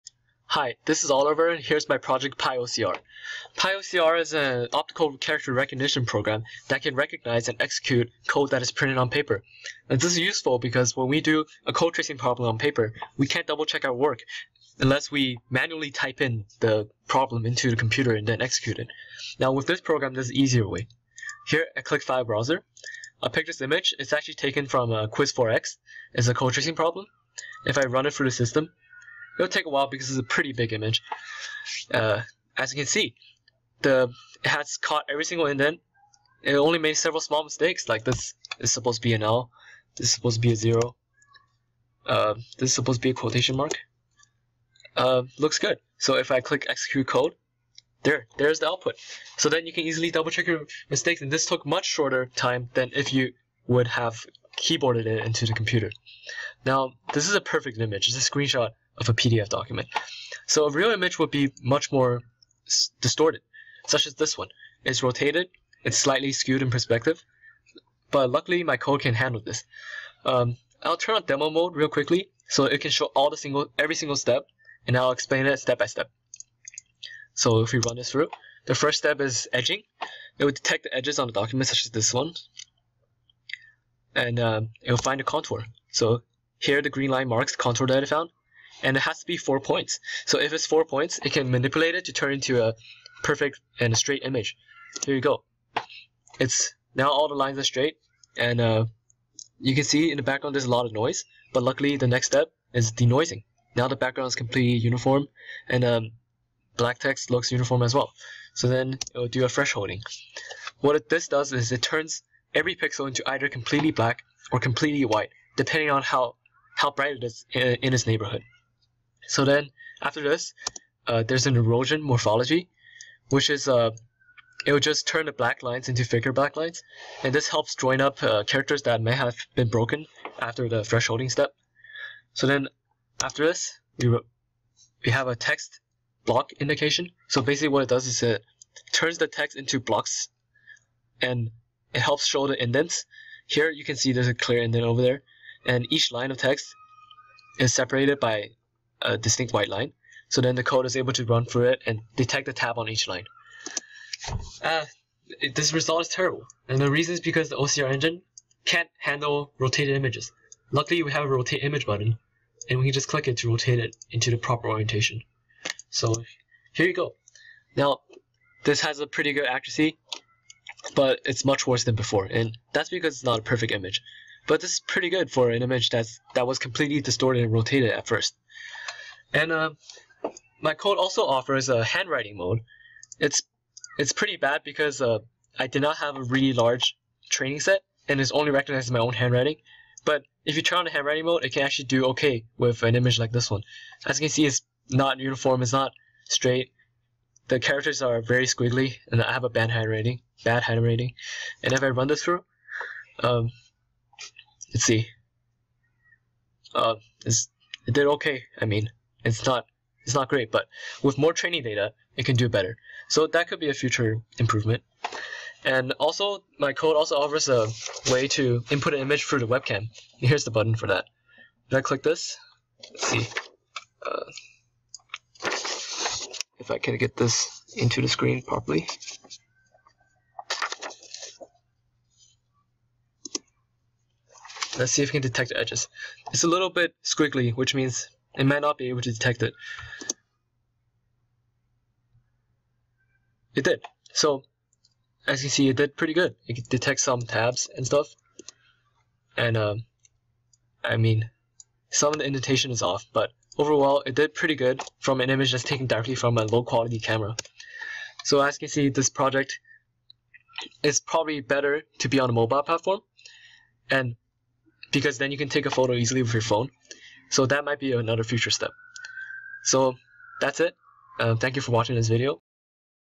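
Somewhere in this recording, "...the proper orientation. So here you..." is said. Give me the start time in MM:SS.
02:44.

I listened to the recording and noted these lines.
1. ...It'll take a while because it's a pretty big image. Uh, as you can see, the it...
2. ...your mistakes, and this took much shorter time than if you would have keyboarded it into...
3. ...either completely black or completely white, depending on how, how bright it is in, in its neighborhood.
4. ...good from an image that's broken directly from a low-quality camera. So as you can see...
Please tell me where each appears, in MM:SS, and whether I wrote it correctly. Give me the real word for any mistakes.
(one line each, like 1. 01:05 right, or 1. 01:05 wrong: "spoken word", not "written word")
1. 00:29 right
2. 00:50 right
3. 01:53 right
4. 04:14 wrong: "taken", not "broken".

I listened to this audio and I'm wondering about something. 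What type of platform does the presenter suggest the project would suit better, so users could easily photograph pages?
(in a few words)
mobile platform.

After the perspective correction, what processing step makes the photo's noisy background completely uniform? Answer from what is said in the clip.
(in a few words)
denoising.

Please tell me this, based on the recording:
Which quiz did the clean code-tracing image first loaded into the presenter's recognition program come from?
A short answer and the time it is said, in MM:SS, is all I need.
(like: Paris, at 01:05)
Quiz4x, at 00:25.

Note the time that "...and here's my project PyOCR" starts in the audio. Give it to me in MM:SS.
00:01.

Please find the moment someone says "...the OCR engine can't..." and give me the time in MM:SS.
02:37.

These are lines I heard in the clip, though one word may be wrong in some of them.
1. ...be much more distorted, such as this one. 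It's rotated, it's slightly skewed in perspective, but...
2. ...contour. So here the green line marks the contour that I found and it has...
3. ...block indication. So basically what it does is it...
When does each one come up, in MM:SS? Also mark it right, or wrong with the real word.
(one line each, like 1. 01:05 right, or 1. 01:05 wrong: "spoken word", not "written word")
1. 01:01 right
2. 01:25 right
3. 02:16 right.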